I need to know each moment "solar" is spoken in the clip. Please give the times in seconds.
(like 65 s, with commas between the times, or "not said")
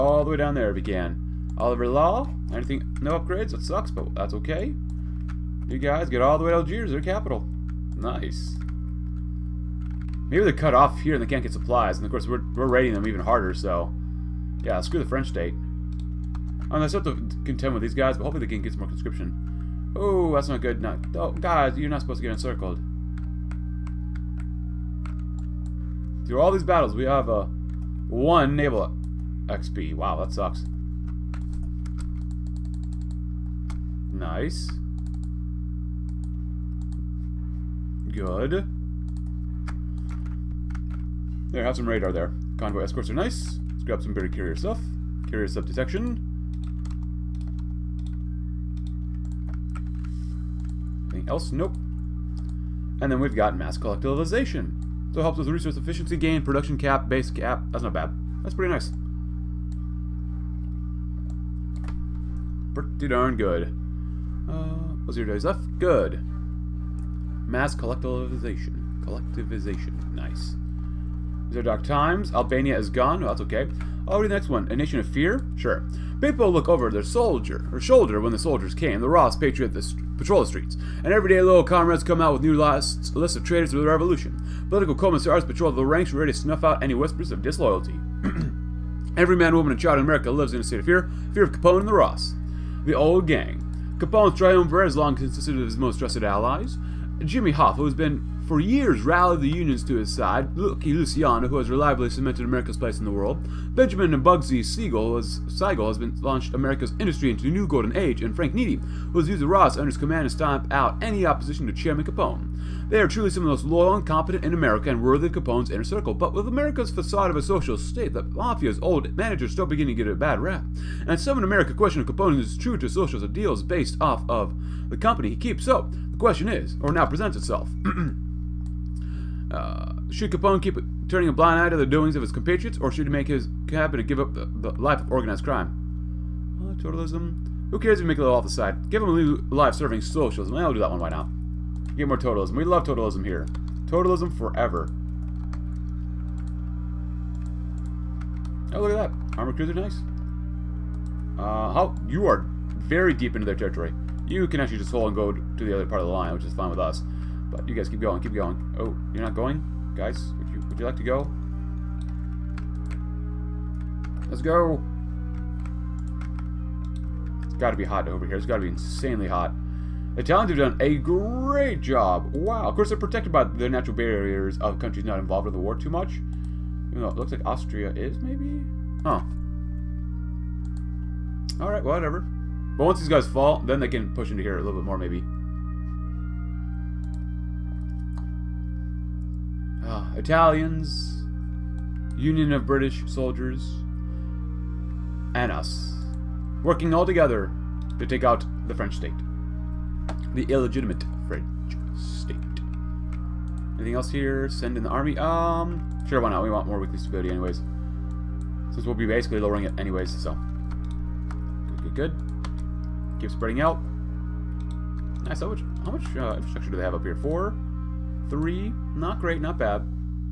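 not said.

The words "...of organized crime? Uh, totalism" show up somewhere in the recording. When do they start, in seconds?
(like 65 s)
135 s.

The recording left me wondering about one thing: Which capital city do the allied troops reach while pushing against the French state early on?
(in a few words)
Algiers.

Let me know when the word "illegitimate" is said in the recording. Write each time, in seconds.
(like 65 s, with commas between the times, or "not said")
200 s.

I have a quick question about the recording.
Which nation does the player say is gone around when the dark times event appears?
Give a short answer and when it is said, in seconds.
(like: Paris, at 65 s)
Albania, at 72 s.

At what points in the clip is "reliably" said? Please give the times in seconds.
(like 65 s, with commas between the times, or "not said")
101 s.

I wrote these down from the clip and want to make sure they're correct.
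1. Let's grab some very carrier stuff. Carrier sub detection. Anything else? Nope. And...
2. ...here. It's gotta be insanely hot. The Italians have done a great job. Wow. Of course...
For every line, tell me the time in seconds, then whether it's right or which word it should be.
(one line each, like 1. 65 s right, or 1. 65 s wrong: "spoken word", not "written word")
1. 43 s right
2. 168 s right.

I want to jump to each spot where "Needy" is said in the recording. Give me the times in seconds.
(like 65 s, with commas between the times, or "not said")
108 s.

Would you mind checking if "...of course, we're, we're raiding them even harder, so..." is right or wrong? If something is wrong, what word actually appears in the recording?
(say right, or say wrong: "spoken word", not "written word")
right.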